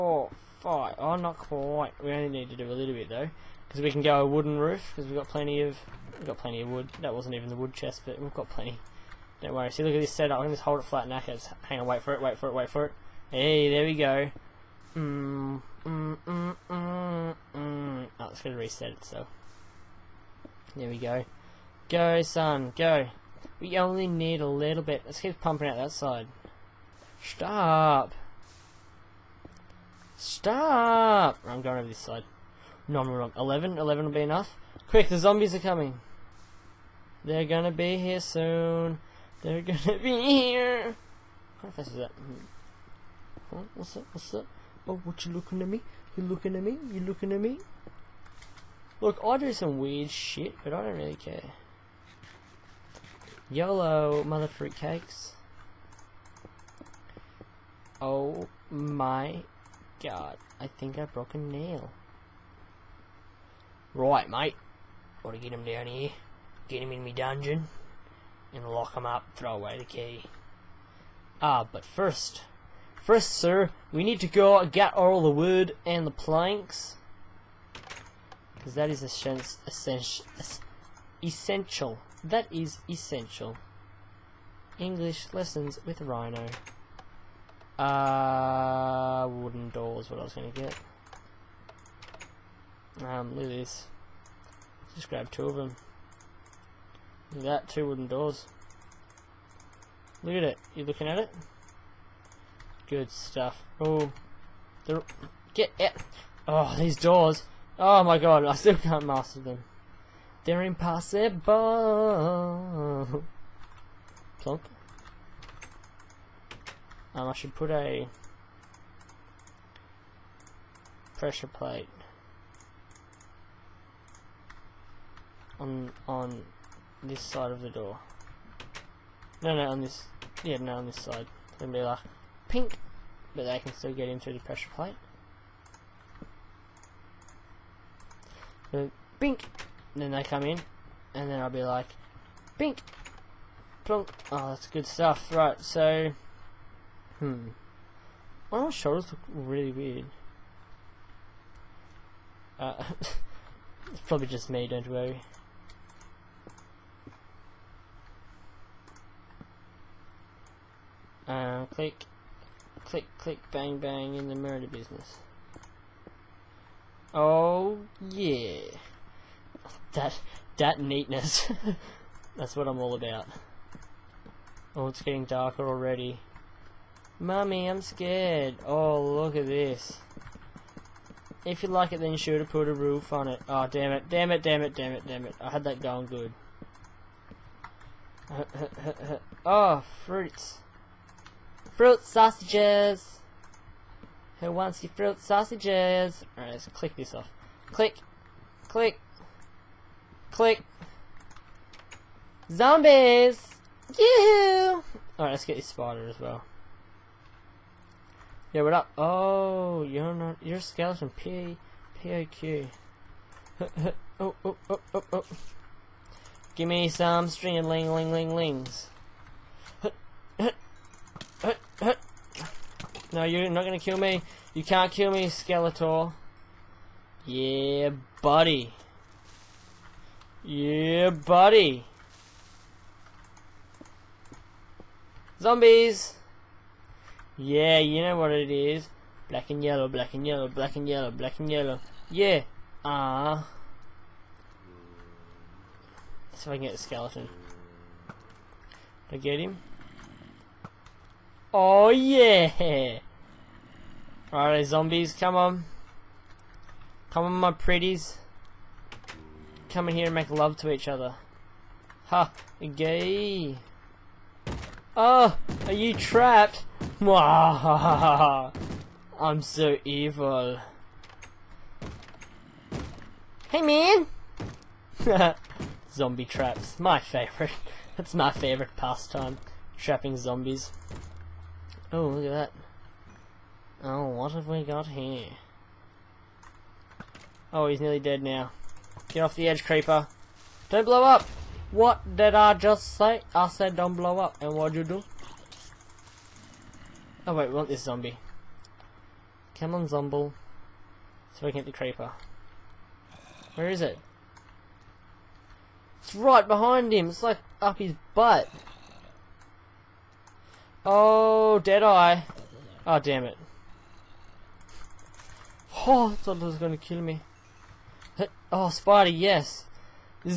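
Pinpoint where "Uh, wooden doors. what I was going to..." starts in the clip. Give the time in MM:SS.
01:27.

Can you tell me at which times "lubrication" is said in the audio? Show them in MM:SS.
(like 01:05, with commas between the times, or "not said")
not said.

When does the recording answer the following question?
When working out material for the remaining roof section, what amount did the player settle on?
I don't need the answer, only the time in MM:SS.
00:33.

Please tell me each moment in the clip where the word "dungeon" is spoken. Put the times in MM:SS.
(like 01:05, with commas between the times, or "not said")
01:07.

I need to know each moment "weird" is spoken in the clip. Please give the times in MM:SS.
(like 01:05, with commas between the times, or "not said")
00:49, 02:29.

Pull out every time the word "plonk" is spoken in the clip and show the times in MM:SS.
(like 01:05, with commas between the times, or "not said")
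01:54, 02:23.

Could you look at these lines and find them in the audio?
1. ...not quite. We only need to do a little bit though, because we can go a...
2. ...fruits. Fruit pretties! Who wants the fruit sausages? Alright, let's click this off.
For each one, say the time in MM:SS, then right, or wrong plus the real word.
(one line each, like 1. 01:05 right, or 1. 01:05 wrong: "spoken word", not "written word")
1. 00:01 right
2. 03:10 wrong: "sausages", not "pretties".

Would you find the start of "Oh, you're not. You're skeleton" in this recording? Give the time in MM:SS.
03:28.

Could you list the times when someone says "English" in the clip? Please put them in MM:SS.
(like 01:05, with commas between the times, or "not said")
01:24.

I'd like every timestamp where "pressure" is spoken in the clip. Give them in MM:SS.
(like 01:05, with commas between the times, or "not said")
02:01, 02:14.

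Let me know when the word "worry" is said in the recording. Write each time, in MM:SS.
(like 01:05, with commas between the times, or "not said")
00:09, 02:34.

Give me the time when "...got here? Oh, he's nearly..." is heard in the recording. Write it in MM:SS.
04:44.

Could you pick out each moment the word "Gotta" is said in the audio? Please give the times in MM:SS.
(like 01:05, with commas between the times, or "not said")
01:05.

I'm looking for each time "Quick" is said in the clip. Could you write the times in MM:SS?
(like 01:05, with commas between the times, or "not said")
00:34.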